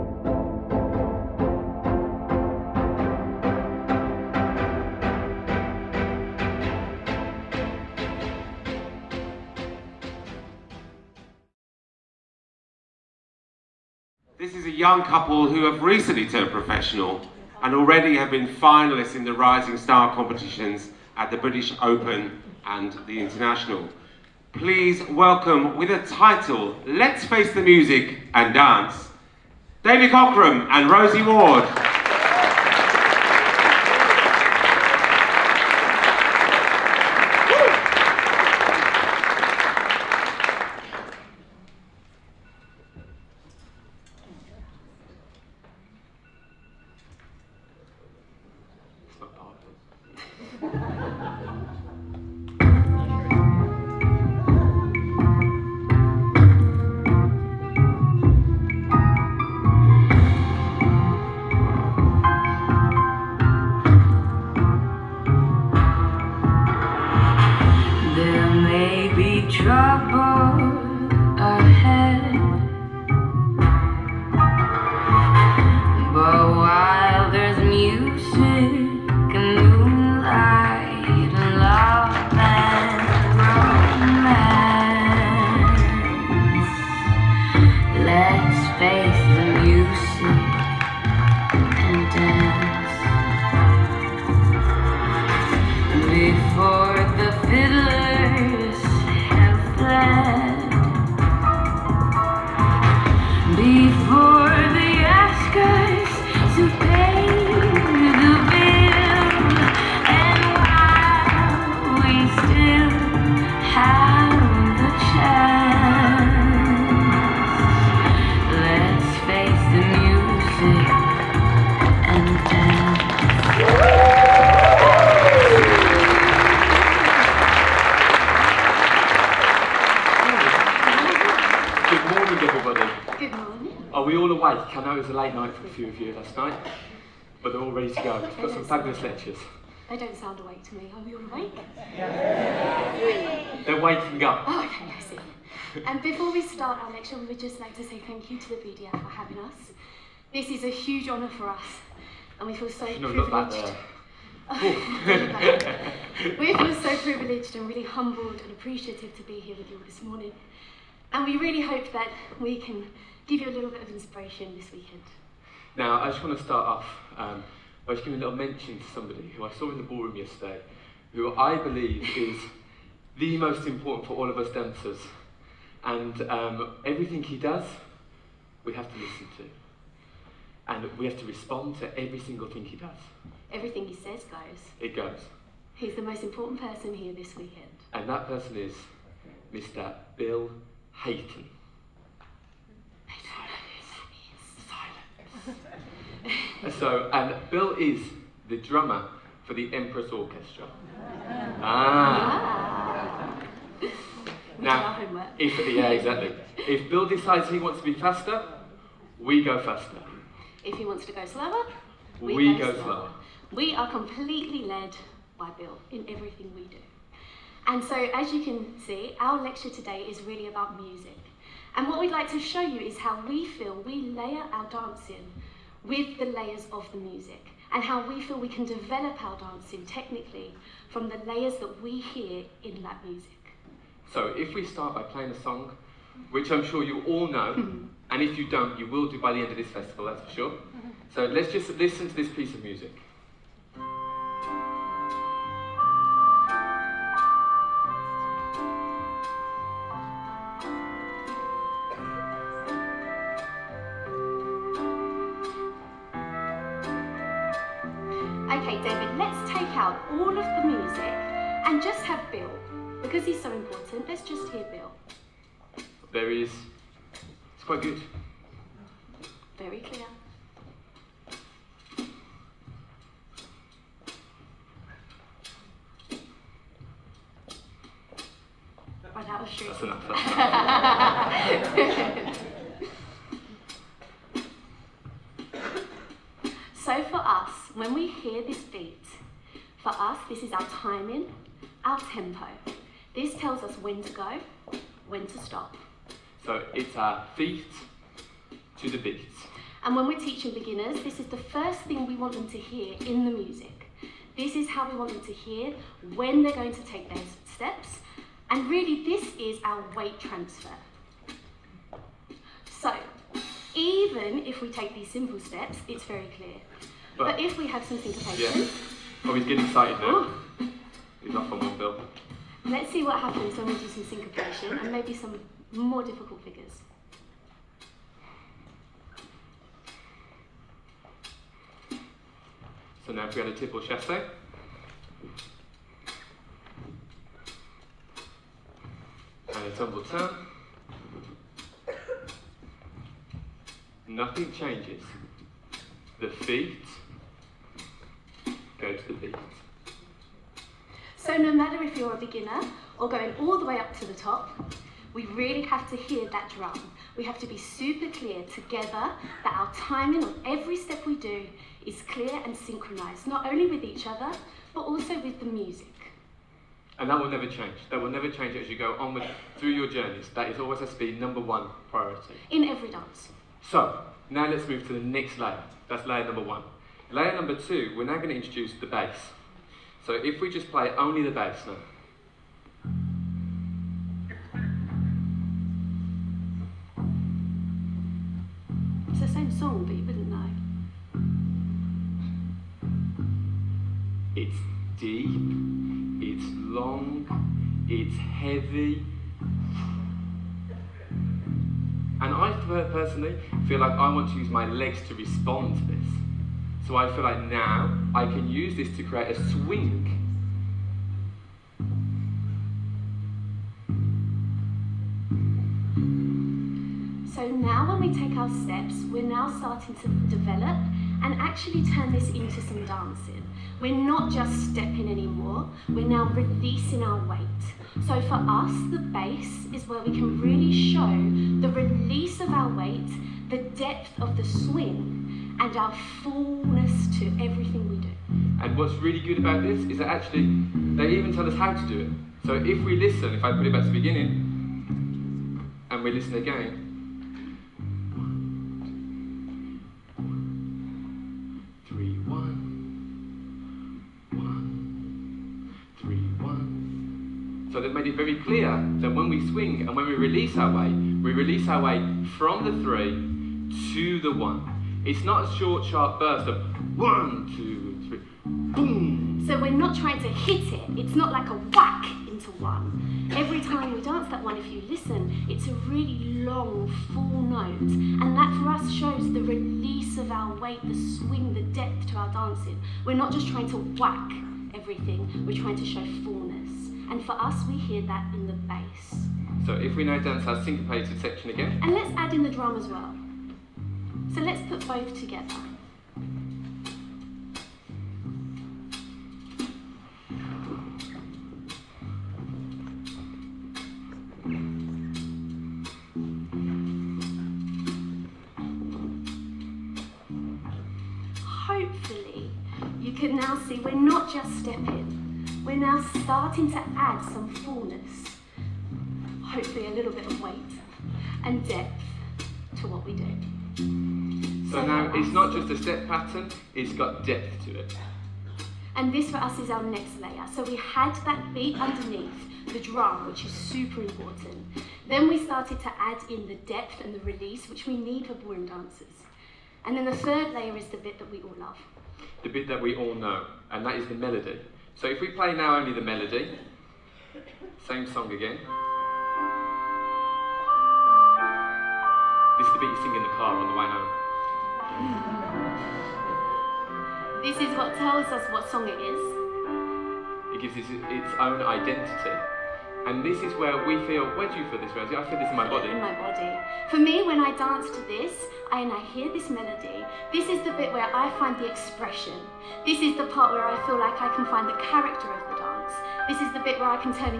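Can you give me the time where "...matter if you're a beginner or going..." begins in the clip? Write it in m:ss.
5:51.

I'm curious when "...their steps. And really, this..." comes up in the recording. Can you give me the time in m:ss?
5:07.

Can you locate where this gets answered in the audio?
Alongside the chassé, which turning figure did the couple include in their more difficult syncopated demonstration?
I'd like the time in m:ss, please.
5:39.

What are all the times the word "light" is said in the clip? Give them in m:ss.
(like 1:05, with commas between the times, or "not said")
not said.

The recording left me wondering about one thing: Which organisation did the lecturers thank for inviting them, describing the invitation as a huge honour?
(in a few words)
BDF.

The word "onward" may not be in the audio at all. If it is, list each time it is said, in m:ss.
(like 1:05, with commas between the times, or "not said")
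6:08.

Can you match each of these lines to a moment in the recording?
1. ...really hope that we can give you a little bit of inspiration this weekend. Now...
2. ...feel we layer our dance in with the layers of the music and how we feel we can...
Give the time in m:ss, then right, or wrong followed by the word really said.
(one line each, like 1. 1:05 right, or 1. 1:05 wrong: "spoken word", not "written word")
1. 2:41 right
2. 3:43 right.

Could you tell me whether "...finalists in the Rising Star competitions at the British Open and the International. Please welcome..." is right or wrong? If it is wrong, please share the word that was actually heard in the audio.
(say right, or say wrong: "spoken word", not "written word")
right.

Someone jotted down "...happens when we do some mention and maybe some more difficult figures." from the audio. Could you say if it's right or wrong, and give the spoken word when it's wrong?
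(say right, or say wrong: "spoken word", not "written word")
wrong: "syncopation", not "mention".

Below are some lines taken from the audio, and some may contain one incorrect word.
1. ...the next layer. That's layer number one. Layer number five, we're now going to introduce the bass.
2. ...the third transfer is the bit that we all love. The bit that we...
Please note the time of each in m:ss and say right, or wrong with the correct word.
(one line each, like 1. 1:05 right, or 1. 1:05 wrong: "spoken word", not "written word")
1. 6:14 wrong: "two", not "five"
2. 9:00 wrong: "layer", not "transfer".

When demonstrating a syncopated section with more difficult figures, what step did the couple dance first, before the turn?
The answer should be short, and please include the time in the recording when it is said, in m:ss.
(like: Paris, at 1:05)
Triple chassé, at 5:33.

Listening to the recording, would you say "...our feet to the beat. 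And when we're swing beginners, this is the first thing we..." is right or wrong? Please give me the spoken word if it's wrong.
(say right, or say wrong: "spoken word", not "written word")
wrong: "teaching", not "swing".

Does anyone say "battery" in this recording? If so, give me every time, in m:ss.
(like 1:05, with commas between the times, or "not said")
not said.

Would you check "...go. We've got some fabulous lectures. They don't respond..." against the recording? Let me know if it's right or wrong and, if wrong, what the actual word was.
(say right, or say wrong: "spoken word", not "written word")
wrong: "sound", not "respond".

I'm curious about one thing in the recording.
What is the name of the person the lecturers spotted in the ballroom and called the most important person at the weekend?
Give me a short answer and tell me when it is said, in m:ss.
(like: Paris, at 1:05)
Bill Hayton, at 3:09.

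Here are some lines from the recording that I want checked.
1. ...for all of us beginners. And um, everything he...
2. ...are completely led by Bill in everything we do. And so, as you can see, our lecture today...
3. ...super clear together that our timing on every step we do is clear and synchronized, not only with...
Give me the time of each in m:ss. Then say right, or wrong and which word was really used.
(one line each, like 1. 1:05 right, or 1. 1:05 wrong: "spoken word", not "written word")
1. 2:54 wrong: "dancers", not "beginners"
2. 3:33 right
3. 5:57 right.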